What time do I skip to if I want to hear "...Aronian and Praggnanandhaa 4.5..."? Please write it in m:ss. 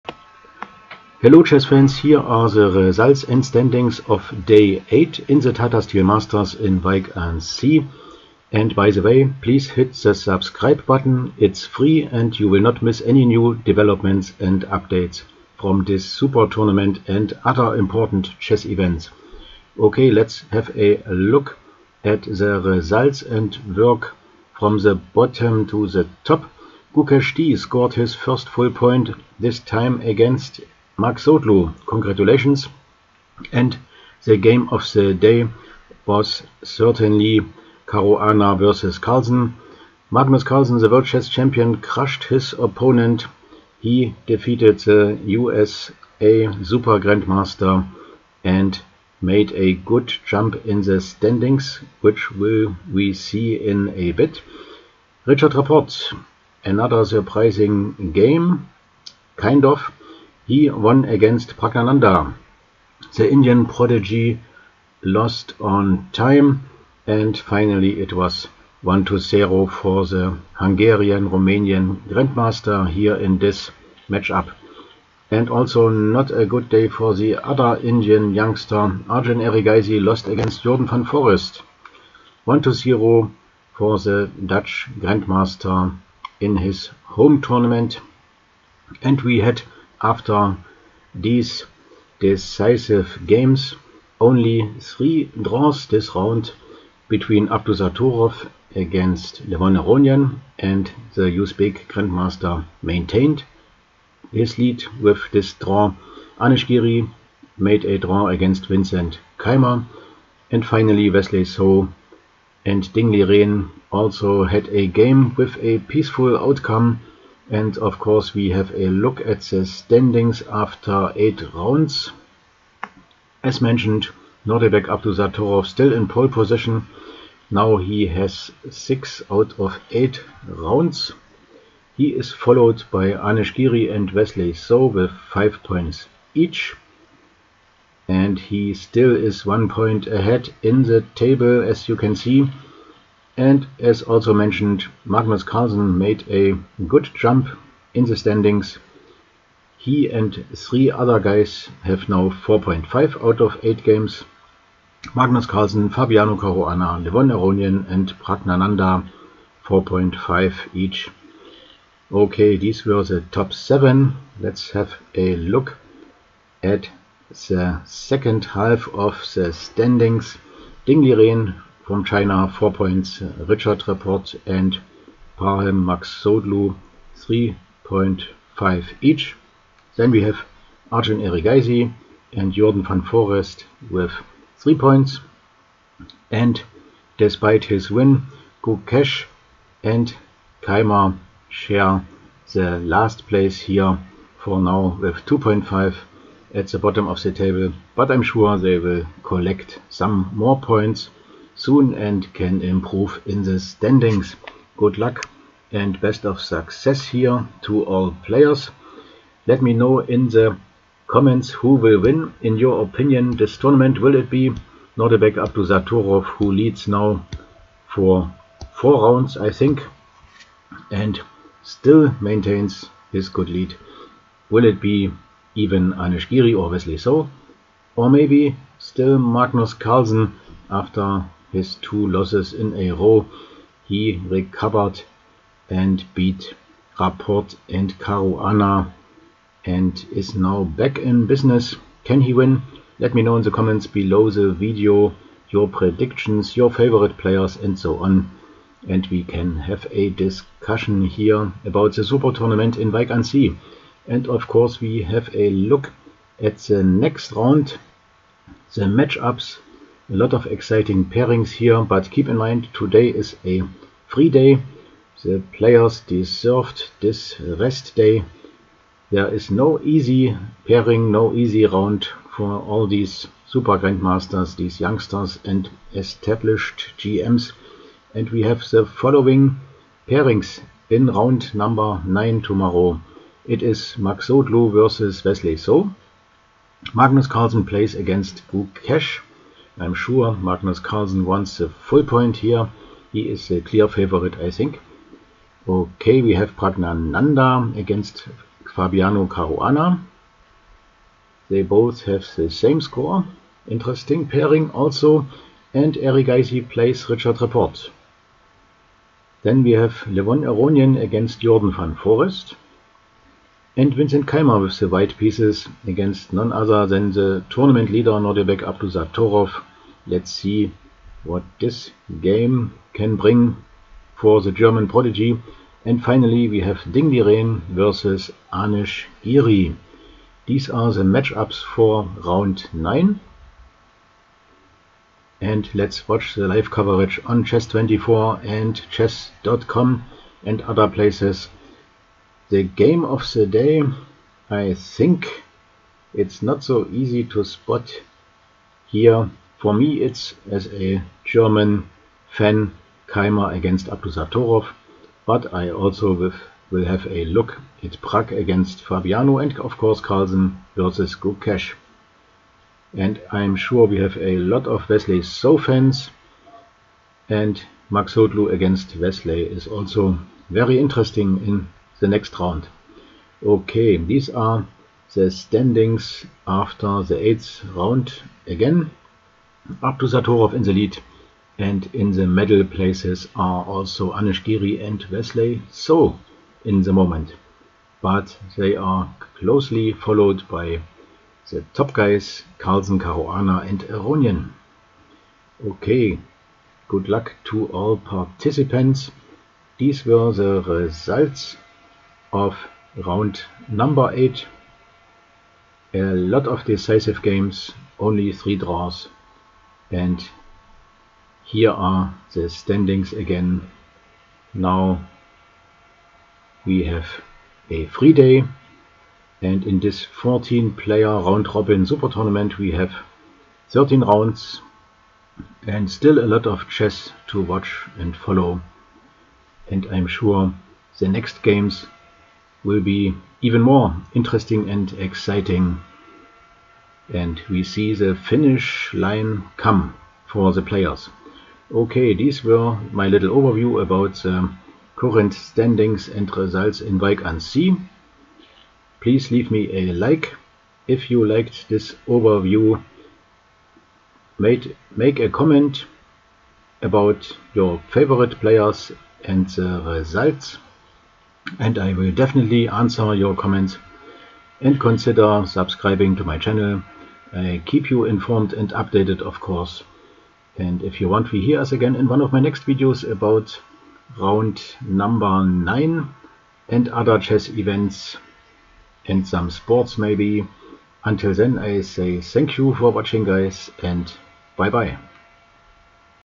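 2:37.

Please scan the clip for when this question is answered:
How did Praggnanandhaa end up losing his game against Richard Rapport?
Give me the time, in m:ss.
1:05.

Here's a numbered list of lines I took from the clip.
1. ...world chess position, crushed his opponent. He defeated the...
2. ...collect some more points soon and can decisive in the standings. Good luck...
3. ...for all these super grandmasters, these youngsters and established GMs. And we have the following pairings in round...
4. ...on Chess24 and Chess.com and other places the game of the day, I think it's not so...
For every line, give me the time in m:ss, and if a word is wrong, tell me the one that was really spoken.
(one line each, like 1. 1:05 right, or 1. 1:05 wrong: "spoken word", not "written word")
1. 0:40 wrong: "champion", not "position"
2. 3:19 wrong: "improve", not "decisive"
3. 4:32 right
4. 5:37 right.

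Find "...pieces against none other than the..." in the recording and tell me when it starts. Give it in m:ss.
5:15.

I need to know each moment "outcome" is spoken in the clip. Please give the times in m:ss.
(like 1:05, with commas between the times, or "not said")
1:56.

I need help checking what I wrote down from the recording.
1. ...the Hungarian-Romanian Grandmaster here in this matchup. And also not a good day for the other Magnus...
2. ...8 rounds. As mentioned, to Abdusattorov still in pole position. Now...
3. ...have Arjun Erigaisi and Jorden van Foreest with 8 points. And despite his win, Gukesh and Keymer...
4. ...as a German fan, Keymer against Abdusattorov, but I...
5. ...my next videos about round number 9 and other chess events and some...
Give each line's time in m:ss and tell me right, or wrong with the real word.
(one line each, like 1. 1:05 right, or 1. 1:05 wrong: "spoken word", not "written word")
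1. 1:10 wrong: "Indian", not "Magnus"
2. 2:01 right
3. 3:00 wrong: "3", not "8"
4. 5:50 right
5. 7:52 right.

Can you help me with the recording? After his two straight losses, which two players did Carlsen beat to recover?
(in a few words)
Rapport and Caruana.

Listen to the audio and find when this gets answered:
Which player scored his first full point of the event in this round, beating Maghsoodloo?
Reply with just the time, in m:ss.
0:26.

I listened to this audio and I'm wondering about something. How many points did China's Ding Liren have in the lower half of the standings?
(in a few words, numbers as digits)
4.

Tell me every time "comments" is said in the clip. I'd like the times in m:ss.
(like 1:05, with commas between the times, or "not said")
3:31, 4:03, 7:35, 7:43.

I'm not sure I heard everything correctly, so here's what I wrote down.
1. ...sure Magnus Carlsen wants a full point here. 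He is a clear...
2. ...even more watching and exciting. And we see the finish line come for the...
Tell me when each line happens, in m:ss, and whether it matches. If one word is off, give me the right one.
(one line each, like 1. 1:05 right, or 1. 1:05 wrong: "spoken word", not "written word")
1. 4:49 right
2. 7:13 wrong: "interesting", not "watching".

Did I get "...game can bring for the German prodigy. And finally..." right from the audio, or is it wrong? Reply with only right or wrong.
right.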